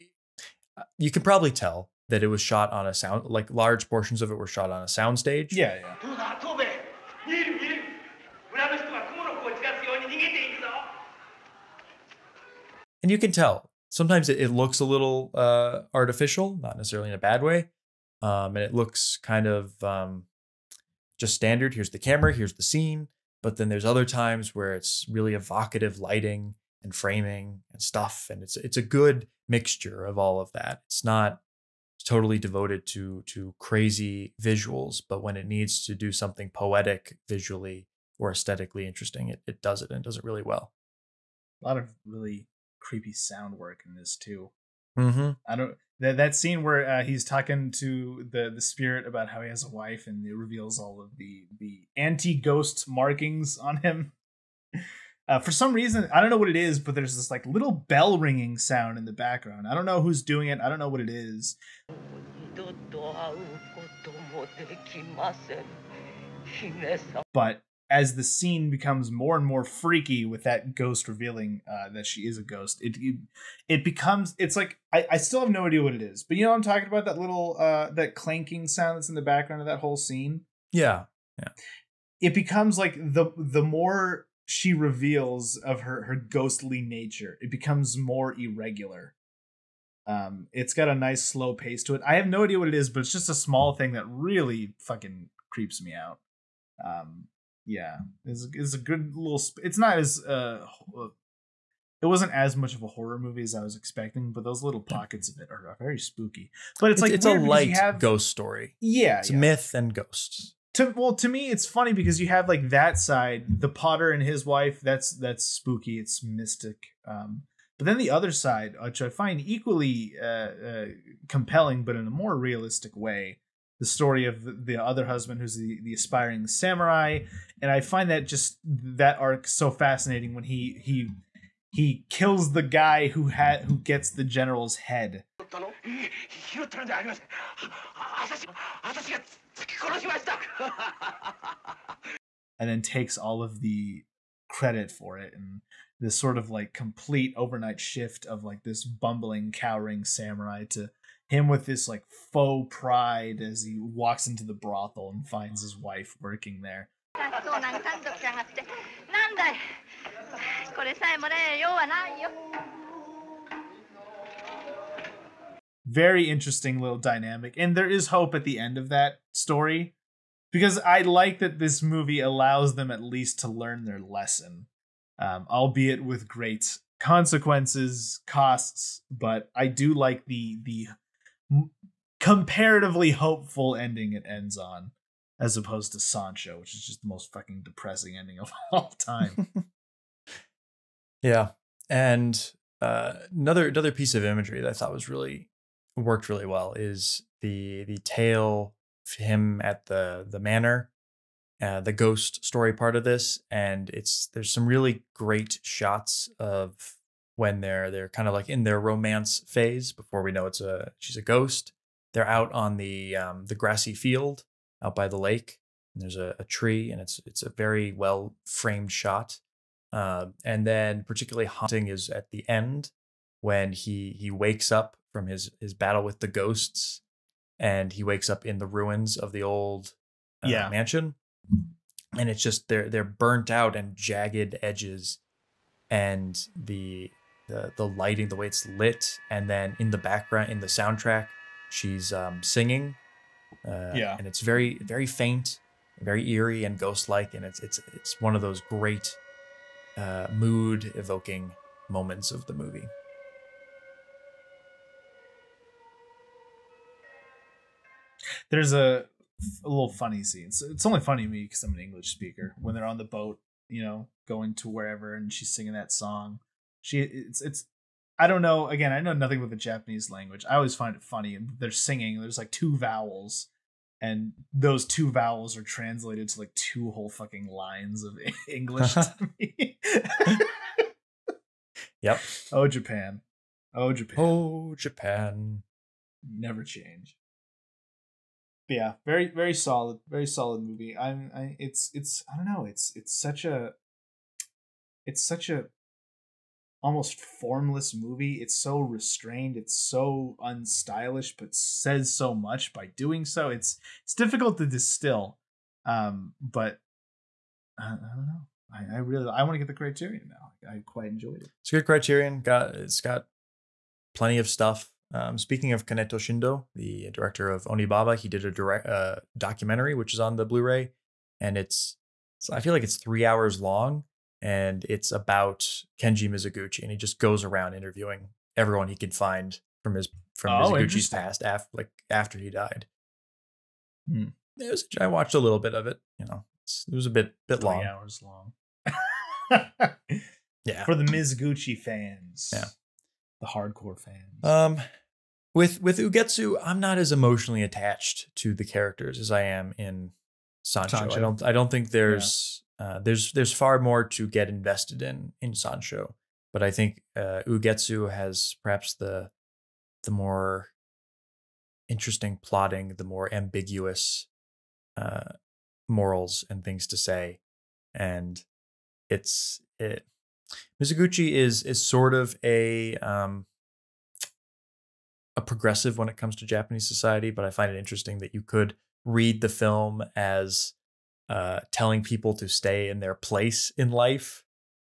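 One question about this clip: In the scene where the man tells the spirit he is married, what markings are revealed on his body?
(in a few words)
Anti ghost markings.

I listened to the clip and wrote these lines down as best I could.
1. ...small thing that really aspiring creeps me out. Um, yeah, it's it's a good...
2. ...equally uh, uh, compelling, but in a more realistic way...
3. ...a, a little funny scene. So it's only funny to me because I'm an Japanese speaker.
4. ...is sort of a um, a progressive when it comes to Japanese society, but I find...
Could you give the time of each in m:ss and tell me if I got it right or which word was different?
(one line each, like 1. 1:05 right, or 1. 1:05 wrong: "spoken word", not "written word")
1. 1:33 wrong: "fucking", not "aspiring"
2. 1:59 right
3. 4:18 wrong: "English", not "Japanese"
4. 6:11 right.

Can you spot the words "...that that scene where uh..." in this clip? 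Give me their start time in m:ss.
0:46.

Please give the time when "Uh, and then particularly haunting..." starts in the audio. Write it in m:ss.
3:39.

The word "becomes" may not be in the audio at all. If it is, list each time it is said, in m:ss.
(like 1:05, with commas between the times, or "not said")
1:08, 1:13, 1:22, 1:27.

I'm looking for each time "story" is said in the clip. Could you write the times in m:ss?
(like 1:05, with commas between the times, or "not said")
1:48, 2:03, 2:49, 3:22.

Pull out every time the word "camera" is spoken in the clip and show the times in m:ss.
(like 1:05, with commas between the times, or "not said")
0:21.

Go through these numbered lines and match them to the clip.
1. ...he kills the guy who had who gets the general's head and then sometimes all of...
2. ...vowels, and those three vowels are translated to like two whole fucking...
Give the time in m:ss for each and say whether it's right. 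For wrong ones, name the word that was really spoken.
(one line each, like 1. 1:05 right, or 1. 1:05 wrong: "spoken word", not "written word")
1. 2:11 wrong: "takes", not "sometimes"
2. 4:32 wrong: "two", not "three".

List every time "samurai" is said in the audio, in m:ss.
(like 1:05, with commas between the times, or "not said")
2:06, 2:30.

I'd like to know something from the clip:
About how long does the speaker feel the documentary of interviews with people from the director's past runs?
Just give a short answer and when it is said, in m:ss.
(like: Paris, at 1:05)
3 hours, at 5:22.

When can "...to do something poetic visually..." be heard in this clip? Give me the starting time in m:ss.
0:35.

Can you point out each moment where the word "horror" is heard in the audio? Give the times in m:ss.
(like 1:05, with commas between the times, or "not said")
1:42.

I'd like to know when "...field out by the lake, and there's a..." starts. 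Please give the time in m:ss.
3:33.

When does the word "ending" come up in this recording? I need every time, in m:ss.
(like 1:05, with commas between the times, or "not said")
3:03, 3:08.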